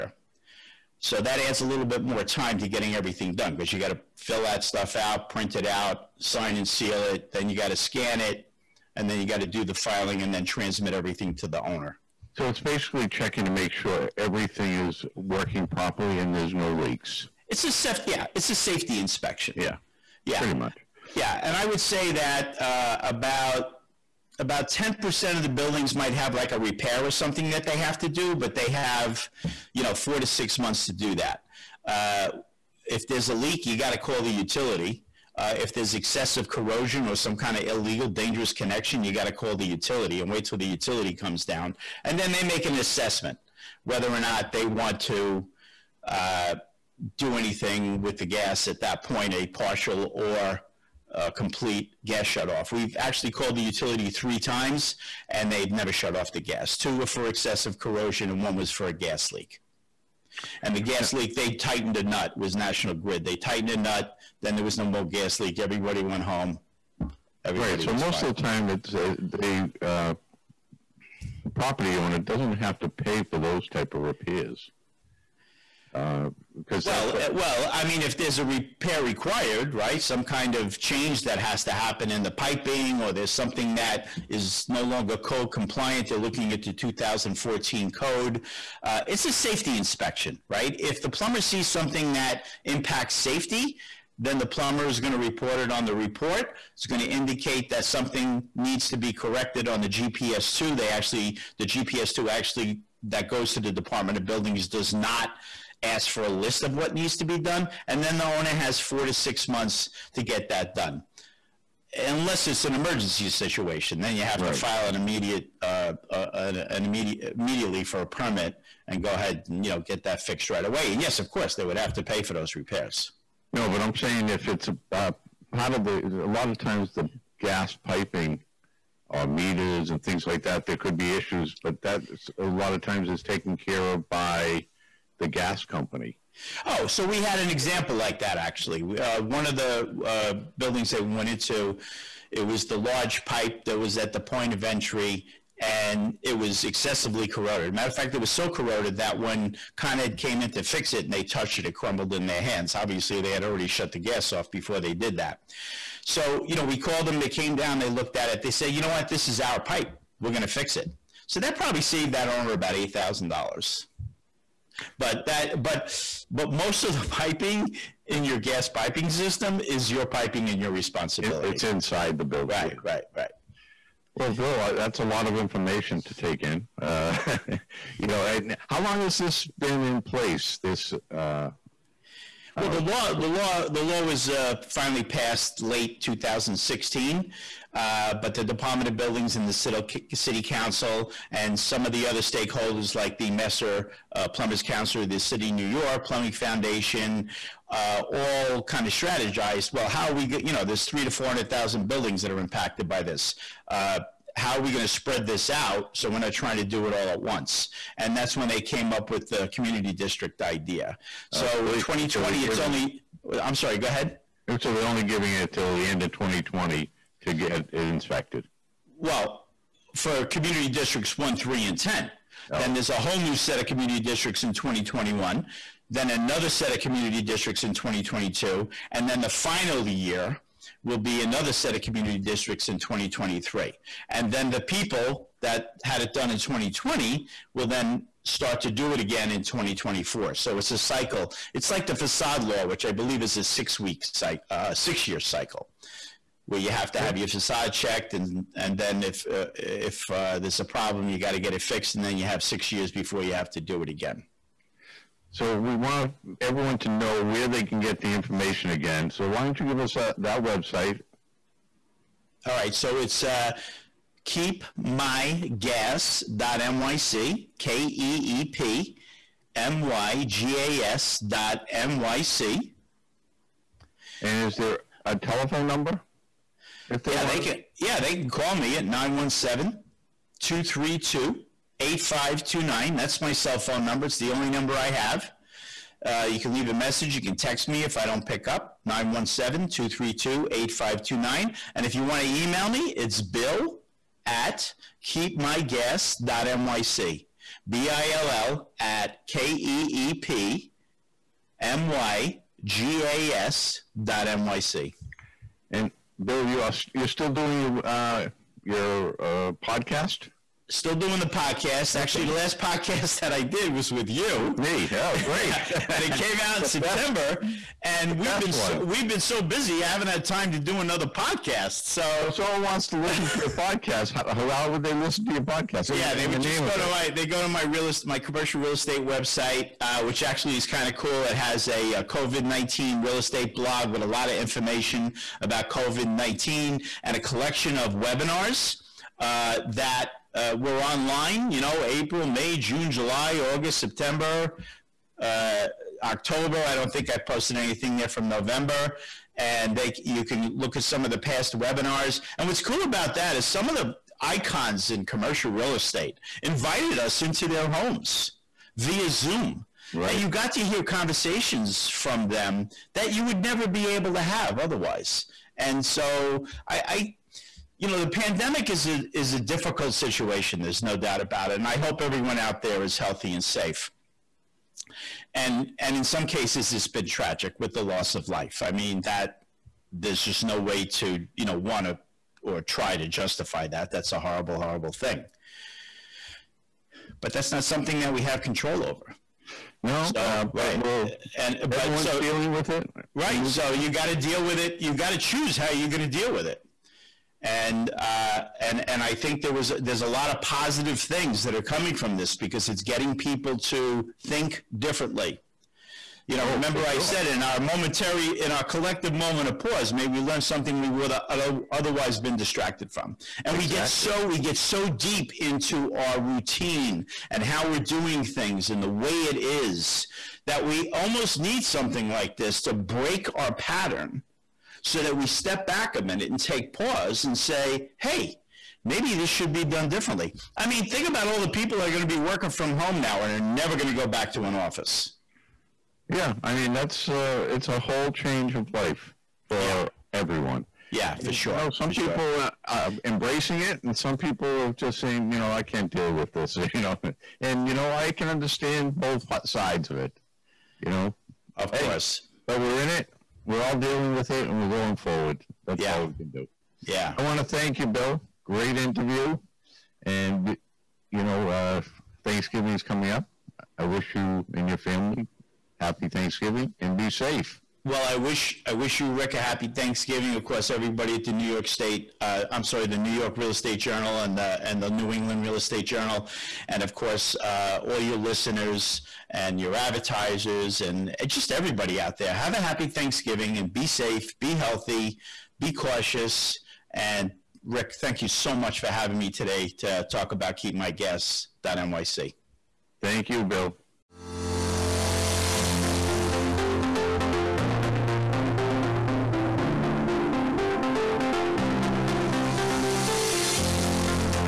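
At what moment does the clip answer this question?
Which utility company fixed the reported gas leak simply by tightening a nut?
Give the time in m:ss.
1:02.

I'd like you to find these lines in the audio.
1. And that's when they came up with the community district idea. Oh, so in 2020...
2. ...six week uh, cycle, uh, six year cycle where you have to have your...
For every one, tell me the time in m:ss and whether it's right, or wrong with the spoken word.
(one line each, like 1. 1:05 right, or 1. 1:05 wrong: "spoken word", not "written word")
1. 3:27 right
2. 4:03 right.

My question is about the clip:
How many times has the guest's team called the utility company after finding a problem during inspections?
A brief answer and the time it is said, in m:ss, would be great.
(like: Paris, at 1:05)
3, at 0:54.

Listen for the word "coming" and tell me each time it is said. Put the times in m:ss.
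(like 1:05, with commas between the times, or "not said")
6:41, 7:42.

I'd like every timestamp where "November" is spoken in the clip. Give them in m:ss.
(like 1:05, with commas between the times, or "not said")
5:48.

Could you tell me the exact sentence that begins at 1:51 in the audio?
Unless it's an emergency situation, then you have right.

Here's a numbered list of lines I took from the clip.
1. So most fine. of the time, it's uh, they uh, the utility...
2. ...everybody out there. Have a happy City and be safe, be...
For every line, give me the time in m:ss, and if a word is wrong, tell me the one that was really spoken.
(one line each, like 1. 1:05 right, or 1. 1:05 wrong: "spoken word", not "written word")
1. 1:07 wrong: "property", not "utility"
2. 8:01 wrong: "Thanksgiving", not "City".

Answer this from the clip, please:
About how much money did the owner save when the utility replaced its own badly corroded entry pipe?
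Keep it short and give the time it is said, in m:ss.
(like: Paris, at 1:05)
$8,000, at 2:42.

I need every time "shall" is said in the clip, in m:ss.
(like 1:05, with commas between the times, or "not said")
not said.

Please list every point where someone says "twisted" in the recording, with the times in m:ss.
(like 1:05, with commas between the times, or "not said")
not said.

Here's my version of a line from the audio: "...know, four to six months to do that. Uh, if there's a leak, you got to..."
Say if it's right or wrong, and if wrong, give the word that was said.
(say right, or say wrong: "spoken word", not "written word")
right.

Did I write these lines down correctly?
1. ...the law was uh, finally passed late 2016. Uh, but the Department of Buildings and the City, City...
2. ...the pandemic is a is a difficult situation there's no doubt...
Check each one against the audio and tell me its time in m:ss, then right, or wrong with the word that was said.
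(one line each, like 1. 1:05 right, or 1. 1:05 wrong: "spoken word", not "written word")
1. 3:03 right
2. 6:07 right.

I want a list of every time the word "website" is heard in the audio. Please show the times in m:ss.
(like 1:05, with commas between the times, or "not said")
4:20, 5:29.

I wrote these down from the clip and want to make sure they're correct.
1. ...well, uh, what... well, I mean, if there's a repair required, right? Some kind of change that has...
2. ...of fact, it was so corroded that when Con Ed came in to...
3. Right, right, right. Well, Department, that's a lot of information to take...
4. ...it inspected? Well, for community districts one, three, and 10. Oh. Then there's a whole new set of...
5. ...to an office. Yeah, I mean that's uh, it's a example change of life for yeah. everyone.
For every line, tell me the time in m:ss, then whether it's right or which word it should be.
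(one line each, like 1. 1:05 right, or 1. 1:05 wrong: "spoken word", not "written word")
1. 1:16 right
2. 2:27 right
3. 2:52 wrong: "Bill", not "Department"
4. 3:37 right
5. 7:14 wrong: "whole", not "example".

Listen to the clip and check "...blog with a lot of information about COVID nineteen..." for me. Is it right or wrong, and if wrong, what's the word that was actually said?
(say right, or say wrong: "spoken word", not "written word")
right.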